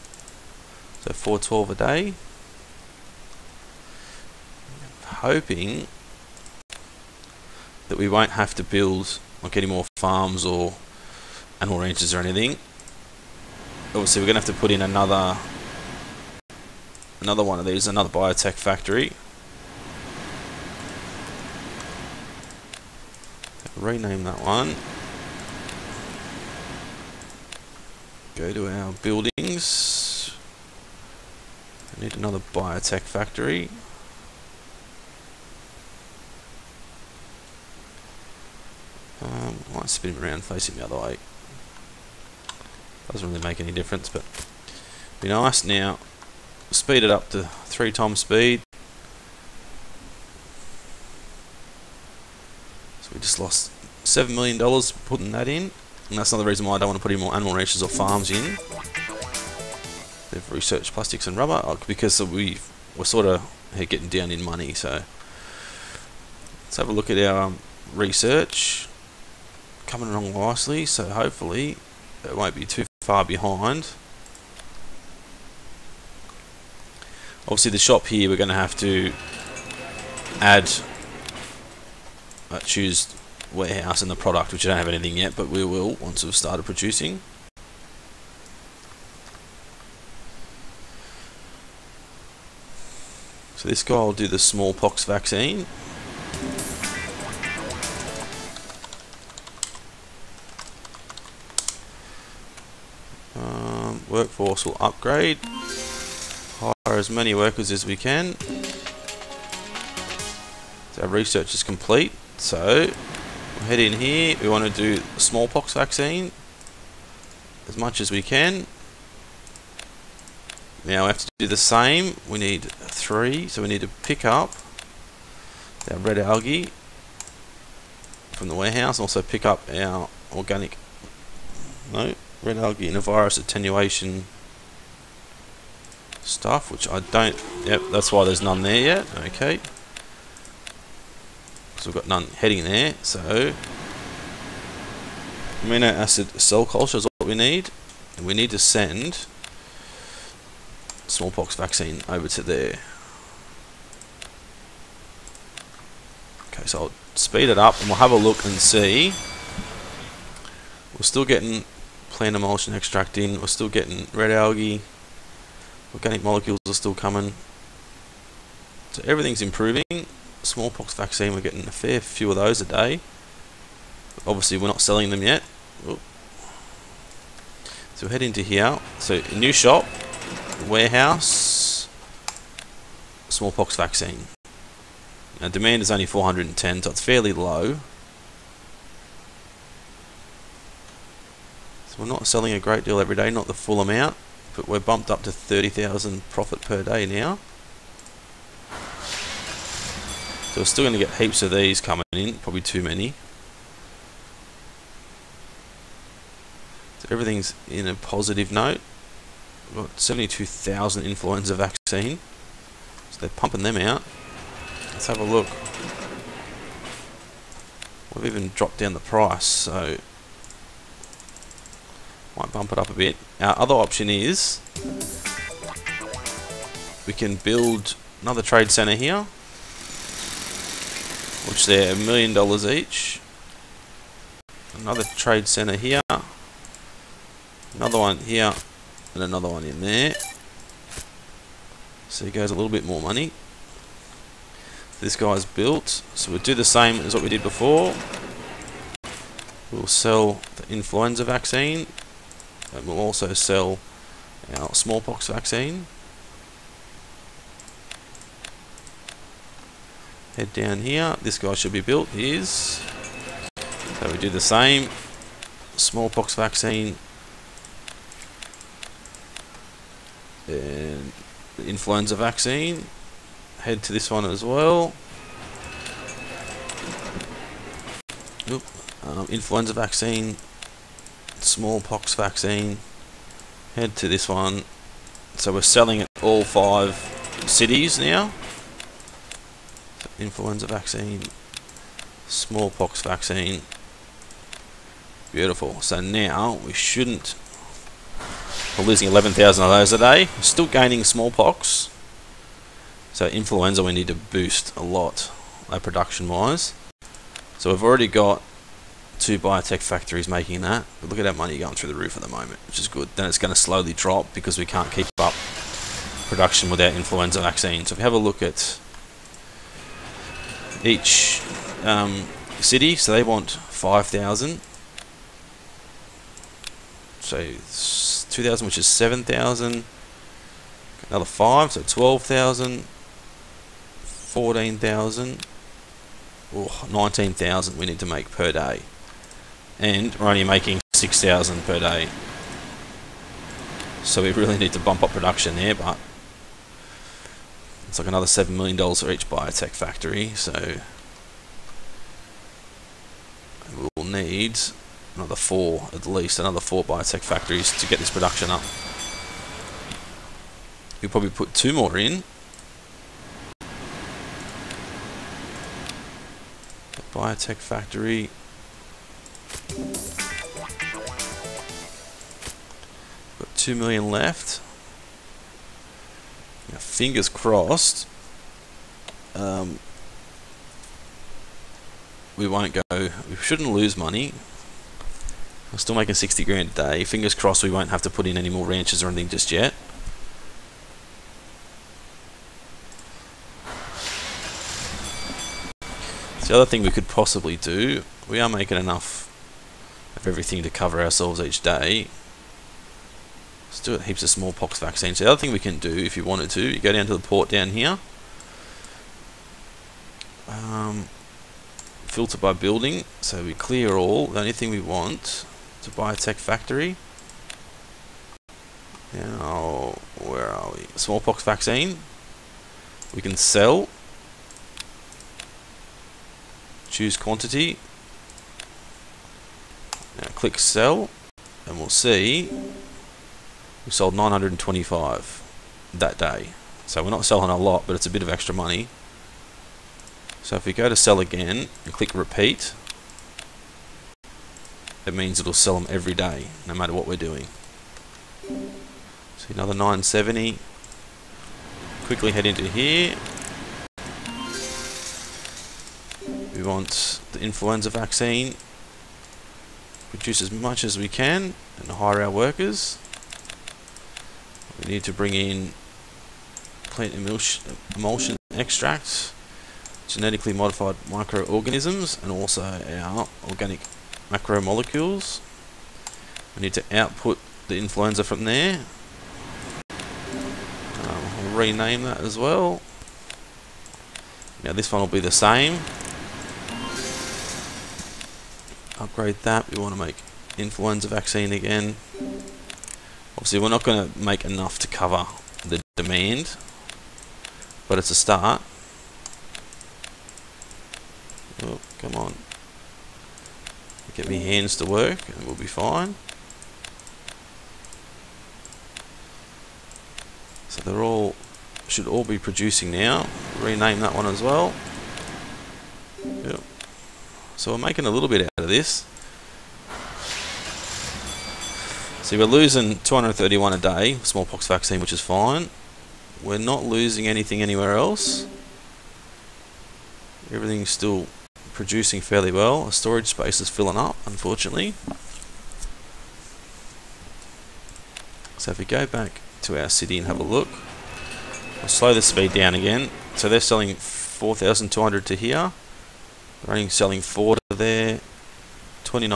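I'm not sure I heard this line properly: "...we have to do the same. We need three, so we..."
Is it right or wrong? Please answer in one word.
right.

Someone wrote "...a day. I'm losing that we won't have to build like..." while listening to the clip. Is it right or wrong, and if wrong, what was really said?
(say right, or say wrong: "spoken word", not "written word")
wrong: "hoping", not "losing".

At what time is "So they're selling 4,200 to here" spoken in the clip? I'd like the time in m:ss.
9:03.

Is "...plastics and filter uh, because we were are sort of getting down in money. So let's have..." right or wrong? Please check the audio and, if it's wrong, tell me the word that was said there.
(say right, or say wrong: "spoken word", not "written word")
wrong: "rubber", not "filter".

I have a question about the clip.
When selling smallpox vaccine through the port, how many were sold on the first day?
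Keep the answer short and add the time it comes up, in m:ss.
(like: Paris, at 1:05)
925, at 7:14.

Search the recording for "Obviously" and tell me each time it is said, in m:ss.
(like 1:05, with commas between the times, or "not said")
0:13, 1:17, 2:54, 8:13.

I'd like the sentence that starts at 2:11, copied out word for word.
No, Red algae and a virus attenuation stuff, which I don't...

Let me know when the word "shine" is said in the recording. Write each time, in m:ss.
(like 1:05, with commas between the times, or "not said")
not said.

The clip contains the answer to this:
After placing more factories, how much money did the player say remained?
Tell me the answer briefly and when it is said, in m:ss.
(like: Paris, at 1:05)
2 million, at 6:13.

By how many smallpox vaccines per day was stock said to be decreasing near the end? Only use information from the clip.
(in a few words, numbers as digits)
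231.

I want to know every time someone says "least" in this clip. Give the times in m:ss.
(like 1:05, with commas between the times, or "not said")
5:56.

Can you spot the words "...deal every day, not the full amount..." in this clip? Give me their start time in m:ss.
3:12.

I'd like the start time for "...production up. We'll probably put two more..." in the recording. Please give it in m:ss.
5:58.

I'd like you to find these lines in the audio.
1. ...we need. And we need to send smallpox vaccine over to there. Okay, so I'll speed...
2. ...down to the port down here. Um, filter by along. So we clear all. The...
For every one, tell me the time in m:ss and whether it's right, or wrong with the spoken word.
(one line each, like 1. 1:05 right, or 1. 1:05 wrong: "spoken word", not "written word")
1. 2:27 right
2. 6:46 wrong: "building", not "along".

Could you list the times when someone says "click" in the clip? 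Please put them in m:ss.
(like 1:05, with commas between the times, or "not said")
7:10, 7:21.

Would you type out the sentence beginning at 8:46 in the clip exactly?
We're not losing anything anywhere else.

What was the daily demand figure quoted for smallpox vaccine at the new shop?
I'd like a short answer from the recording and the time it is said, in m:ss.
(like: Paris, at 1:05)
410, at 3:06.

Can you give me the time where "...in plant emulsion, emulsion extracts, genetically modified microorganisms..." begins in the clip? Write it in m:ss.
7:45.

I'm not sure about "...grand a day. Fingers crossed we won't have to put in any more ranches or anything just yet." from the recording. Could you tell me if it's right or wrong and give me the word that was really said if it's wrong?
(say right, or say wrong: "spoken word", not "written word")
right.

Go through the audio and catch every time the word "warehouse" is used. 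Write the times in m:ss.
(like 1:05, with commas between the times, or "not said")
1:23, 2:08, 3:00.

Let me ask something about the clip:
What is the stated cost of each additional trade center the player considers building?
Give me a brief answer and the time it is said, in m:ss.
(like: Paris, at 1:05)
a million dollars, at 3:51.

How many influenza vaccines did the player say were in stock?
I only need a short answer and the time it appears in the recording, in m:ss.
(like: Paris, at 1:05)
72,000, at 3:30.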